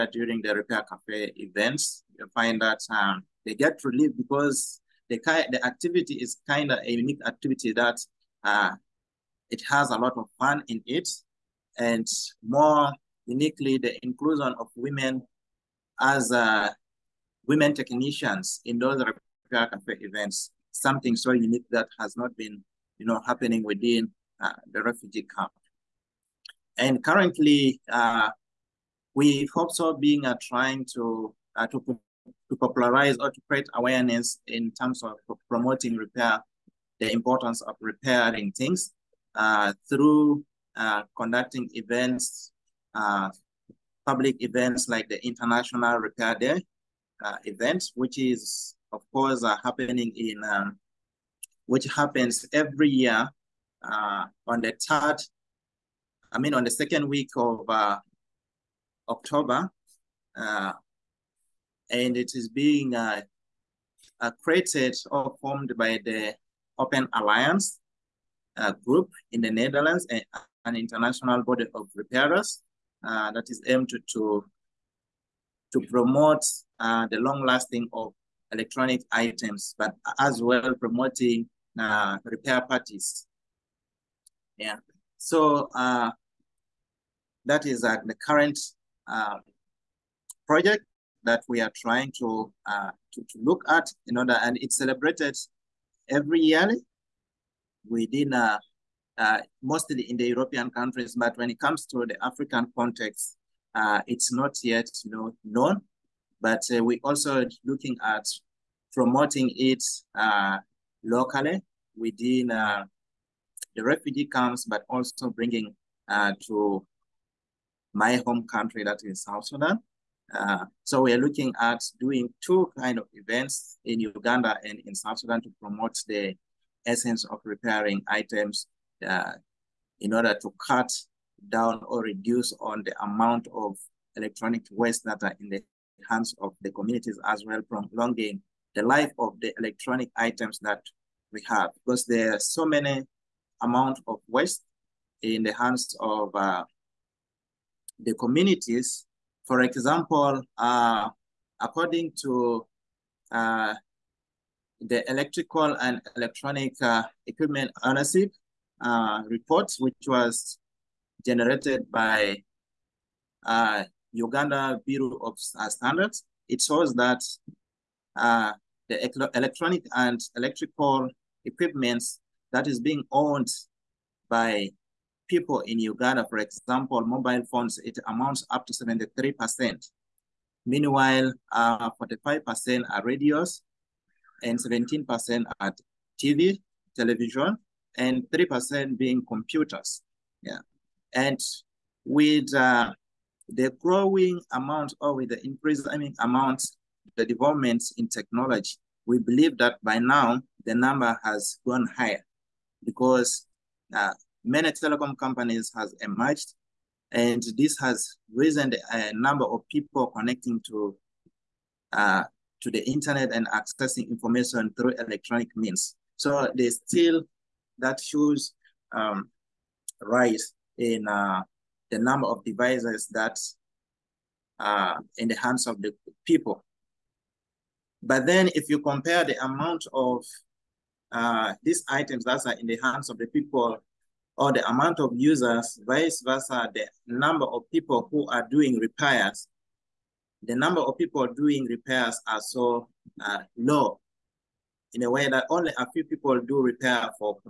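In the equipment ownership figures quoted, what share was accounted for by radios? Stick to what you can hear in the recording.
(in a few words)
45%.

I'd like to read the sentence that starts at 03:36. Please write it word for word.
So there's still that shows um, rise in uh, the number of devices that are uh, in the hands of the people.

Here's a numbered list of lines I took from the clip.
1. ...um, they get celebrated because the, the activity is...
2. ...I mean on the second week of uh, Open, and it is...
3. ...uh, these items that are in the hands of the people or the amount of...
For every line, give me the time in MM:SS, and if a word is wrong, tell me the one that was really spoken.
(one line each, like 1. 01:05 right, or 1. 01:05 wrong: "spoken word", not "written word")
1. 00:02 wrong: "relieved", not "celebrated"
2. 00:56 wrong: "October", not "Open"
3. 03:51 right.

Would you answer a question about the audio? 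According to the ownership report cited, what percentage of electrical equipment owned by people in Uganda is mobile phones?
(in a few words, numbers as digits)
73%.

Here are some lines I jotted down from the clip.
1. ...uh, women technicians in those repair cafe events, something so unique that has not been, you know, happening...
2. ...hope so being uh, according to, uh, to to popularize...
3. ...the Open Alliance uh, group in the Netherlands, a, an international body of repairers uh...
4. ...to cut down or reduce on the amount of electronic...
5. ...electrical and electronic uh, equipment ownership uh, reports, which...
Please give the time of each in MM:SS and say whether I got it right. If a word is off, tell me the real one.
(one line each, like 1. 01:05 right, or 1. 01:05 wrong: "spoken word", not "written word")
1. 00:16 right
2. 00:29 wrong: "trying", not "according"
3. 01:06 right
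4. 02:10 right
5. 02:35 right.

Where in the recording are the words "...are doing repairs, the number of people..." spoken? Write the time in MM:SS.
03:58.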